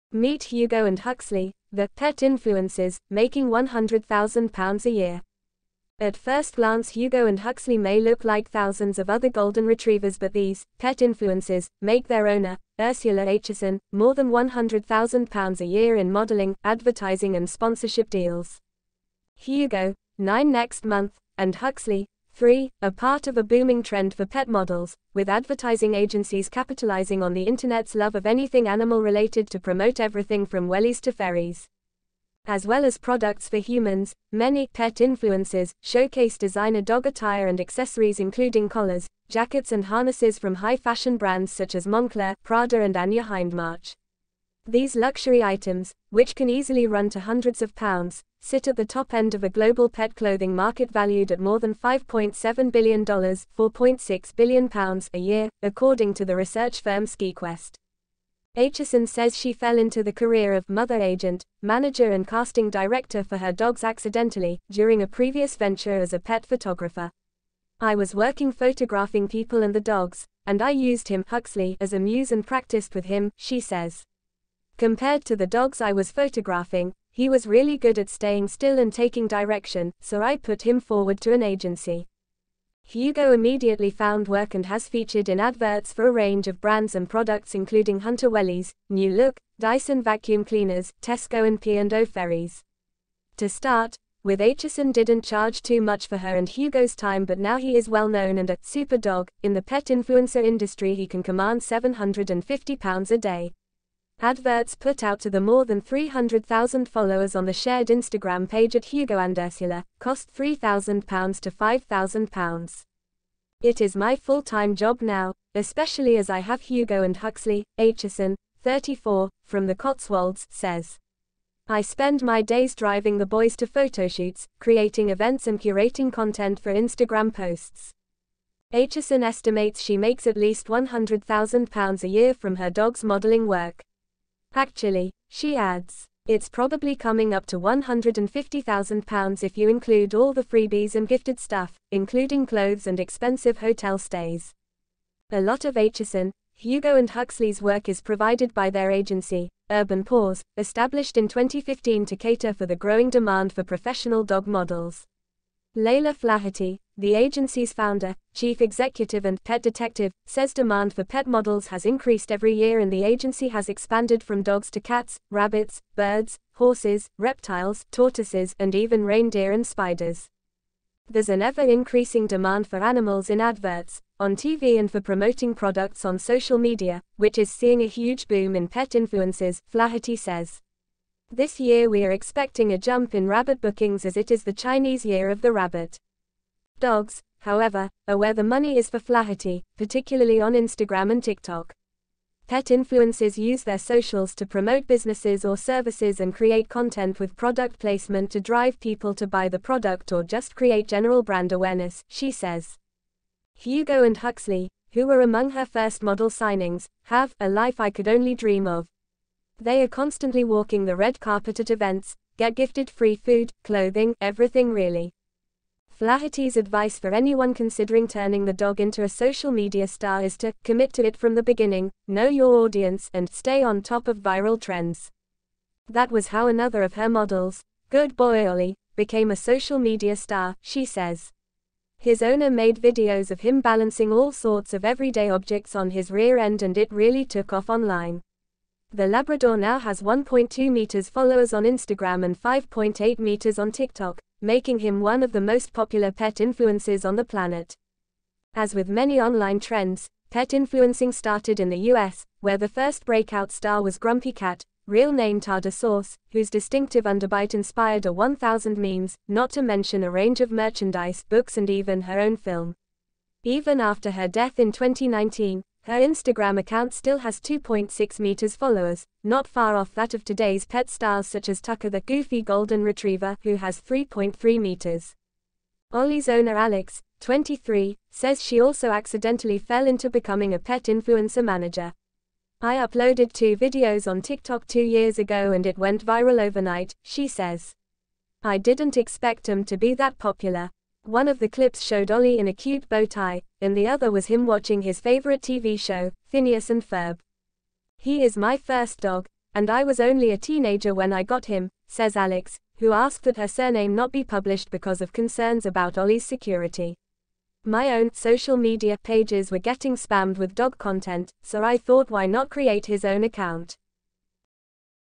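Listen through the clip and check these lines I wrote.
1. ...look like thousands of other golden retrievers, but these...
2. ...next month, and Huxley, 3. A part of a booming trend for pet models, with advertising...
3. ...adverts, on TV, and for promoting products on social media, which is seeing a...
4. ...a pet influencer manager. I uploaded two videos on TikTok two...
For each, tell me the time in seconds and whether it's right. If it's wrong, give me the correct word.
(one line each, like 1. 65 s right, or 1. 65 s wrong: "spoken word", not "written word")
1. 8 s right
2. 20 s right
3. 173 s right
4. 280 s right.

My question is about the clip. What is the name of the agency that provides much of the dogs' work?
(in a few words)
Urban Paws.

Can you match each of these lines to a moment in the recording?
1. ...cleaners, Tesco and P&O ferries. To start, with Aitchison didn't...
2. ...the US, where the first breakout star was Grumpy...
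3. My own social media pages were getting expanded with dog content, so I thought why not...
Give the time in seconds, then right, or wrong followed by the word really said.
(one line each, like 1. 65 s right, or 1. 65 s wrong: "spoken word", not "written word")
1. 90 s right
2. 251 s right
3. 307 s wrong: "spammed", not "expanded".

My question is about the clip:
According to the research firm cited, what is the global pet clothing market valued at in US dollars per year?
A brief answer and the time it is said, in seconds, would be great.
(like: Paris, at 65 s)
$5.7 billion, at 51 s.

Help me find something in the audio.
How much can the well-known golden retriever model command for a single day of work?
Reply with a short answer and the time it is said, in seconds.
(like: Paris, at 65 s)
£750, at 101 s.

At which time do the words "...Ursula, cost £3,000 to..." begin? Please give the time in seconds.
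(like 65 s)
109 s.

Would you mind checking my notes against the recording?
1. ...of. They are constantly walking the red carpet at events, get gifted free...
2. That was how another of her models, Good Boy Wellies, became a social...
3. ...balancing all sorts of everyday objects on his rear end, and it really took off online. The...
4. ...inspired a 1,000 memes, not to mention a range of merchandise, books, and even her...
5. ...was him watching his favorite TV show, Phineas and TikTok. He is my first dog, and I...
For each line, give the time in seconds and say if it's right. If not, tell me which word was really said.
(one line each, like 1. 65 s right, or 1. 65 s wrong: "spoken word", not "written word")
1. 208 s right
2. 225 s wrong: "Ollie", not "Wellies"
3. 233 s right
4. 257 s right
5. 294 s wrong: "Ferb", not "TikTok".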